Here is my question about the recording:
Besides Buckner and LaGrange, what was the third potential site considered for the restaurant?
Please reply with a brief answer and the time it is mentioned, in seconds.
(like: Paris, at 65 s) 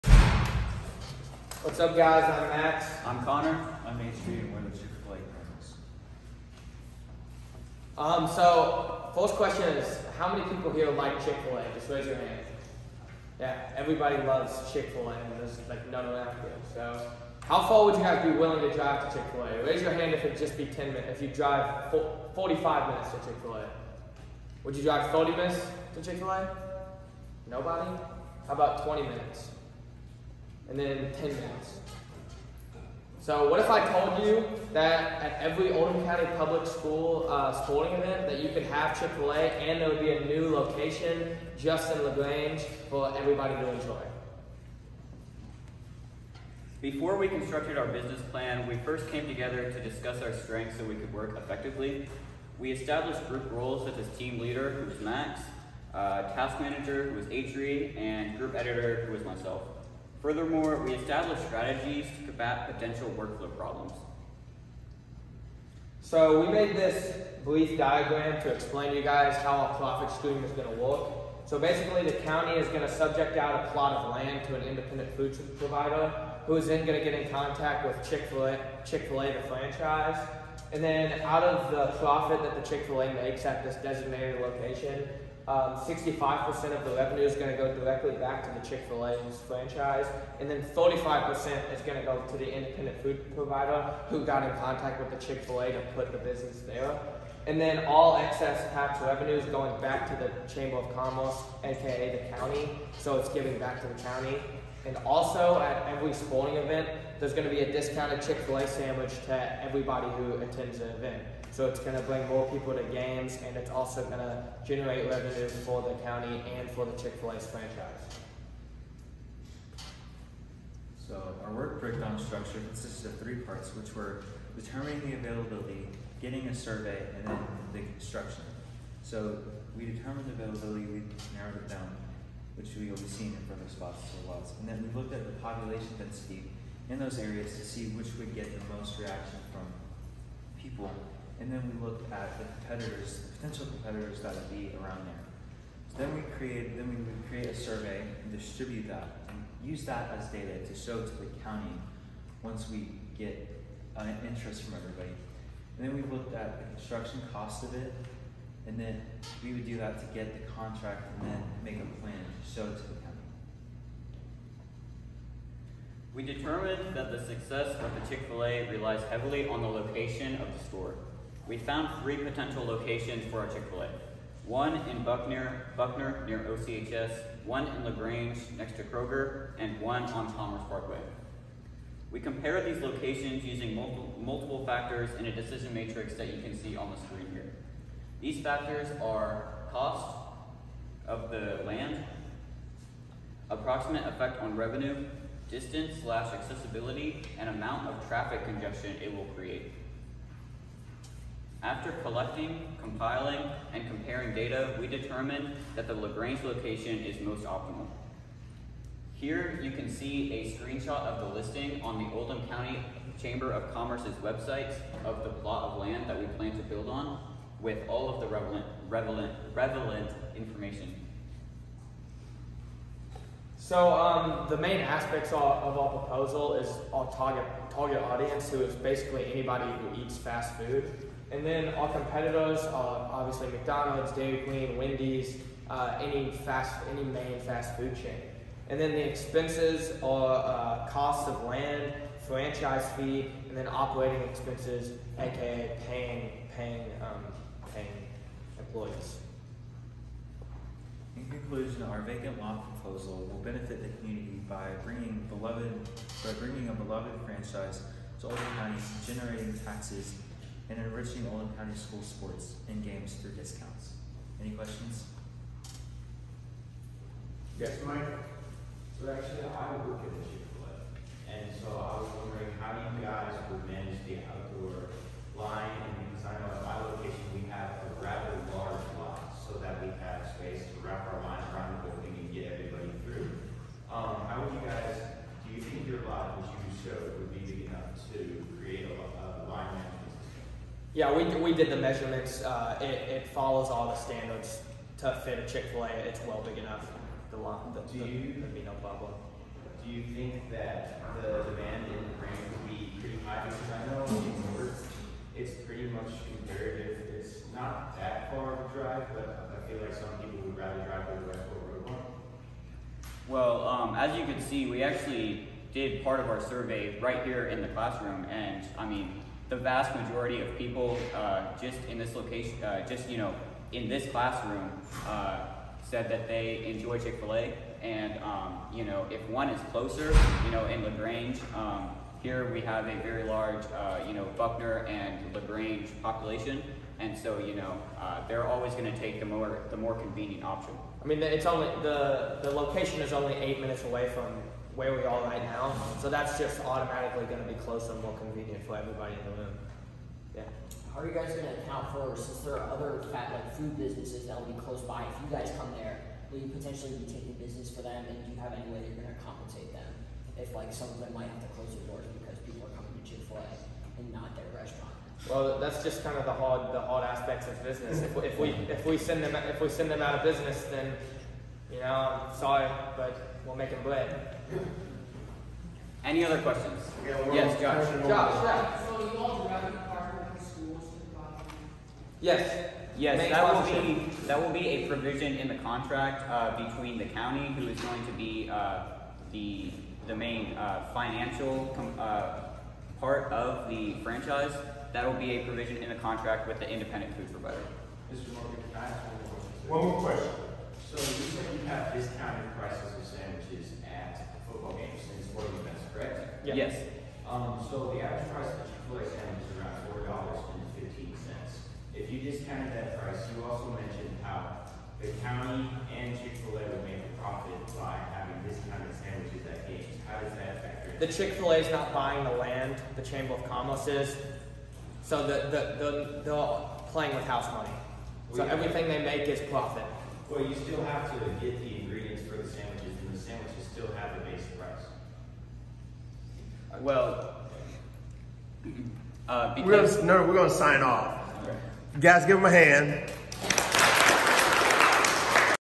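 Commerce Parkway, at 180 s.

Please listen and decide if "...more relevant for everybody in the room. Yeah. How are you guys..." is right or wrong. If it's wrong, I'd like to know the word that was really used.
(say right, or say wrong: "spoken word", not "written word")
wrong: "convenient", not "relevant".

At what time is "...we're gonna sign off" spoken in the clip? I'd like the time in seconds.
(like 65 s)
440 s.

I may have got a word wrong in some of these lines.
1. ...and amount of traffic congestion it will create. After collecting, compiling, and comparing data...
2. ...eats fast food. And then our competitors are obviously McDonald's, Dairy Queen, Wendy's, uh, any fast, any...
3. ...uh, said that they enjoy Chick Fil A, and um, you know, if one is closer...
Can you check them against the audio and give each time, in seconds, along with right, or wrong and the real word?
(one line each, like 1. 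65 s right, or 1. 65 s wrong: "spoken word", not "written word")
1. 197 s right
2. 230 s right
3. 325 s right.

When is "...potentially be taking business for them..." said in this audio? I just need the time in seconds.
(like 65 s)
356 s.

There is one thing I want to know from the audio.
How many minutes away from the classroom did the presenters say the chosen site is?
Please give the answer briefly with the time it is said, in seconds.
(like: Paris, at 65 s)
8 minutes, at 343 s.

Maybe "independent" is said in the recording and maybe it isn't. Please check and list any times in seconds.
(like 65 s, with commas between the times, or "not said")
74 s, 92 s, 396 s.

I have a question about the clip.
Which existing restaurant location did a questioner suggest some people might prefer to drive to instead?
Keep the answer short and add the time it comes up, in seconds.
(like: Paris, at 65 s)
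Westport Road, at 311 s.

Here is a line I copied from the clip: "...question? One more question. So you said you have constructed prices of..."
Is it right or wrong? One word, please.
wrong.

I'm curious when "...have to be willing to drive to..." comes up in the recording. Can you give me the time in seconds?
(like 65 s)
18 s.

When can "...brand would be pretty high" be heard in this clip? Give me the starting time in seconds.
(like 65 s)
302 s.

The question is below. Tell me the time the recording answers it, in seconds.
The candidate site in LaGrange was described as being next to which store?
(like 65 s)
178 s.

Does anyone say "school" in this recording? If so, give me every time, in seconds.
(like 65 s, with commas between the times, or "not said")
36 s, 261 s, 380 s.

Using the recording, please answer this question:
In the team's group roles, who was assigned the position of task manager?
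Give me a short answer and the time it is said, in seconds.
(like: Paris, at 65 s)
Adrian, at 57 s.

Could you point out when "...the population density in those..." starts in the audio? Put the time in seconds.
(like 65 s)
135 s.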